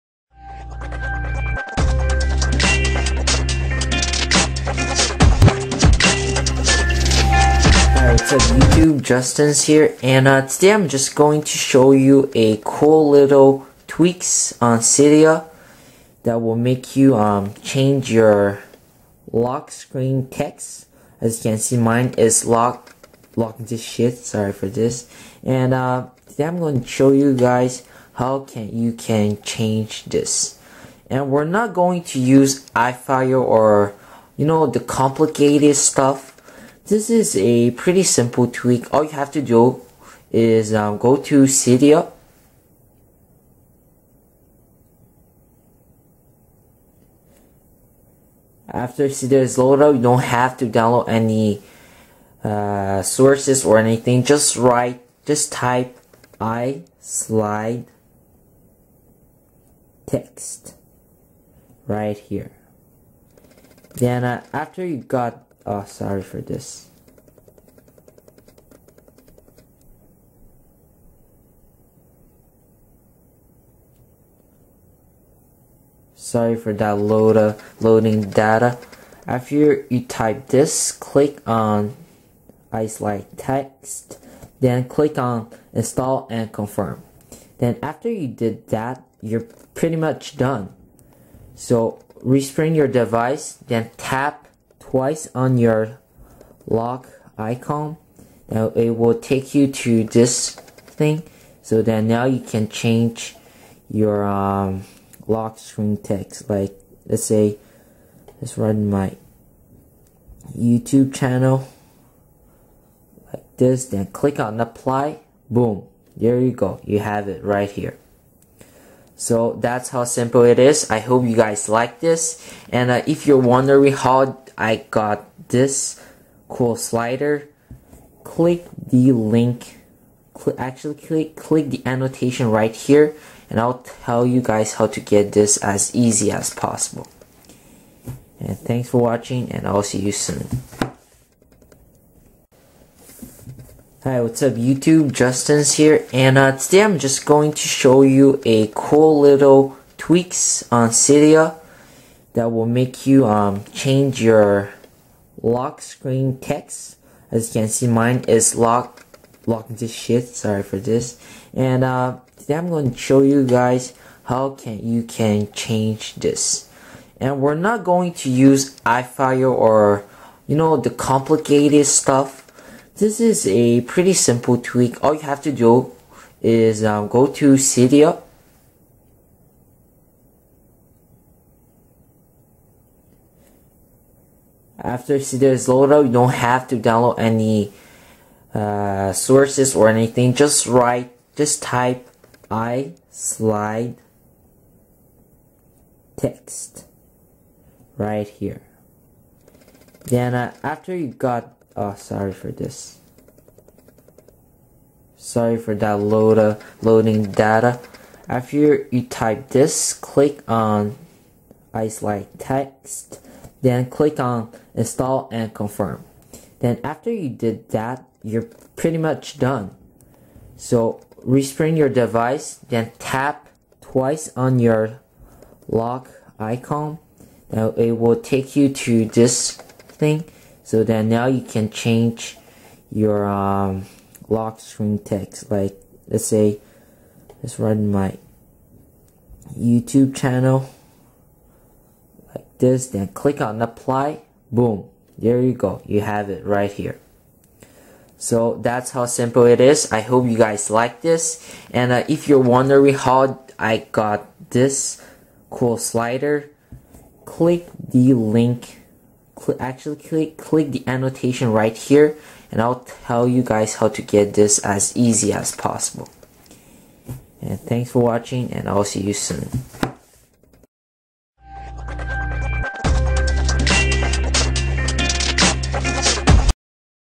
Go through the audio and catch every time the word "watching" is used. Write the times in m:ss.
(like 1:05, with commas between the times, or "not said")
2:19, 4:28.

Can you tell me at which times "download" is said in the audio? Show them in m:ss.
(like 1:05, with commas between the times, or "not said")
0:50, 3:06.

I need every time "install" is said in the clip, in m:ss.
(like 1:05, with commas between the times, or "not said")
1:25, 3:34.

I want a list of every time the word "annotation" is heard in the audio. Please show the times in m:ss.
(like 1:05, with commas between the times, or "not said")
2:11, 4:20.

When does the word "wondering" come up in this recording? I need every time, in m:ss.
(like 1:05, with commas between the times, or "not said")
2:03, 4:12.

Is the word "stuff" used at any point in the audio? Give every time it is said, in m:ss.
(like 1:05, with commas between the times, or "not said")
0:35, 2:51.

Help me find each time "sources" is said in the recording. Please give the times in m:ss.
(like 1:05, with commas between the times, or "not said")
0:53, 3:09.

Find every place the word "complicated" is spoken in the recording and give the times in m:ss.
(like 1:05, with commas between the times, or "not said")
0:34, 2:50.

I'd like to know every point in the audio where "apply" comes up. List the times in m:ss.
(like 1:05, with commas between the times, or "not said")
1:54, 4:03.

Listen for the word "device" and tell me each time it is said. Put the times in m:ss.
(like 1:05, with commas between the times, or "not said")
1:32, 3:41.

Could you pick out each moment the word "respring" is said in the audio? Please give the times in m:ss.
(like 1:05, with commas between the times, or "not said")
1:32, 3:41.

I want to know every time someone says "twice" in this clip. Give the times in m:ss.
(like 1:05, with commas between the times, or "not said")
1:34, 3:43.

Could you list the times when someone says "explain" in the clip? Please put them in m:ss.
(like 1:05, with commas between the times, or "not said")
not said.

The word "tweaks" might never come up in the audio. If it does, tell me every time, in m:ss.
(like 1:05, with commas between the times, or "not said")
0:13, 0:38, 2:29, 2:54.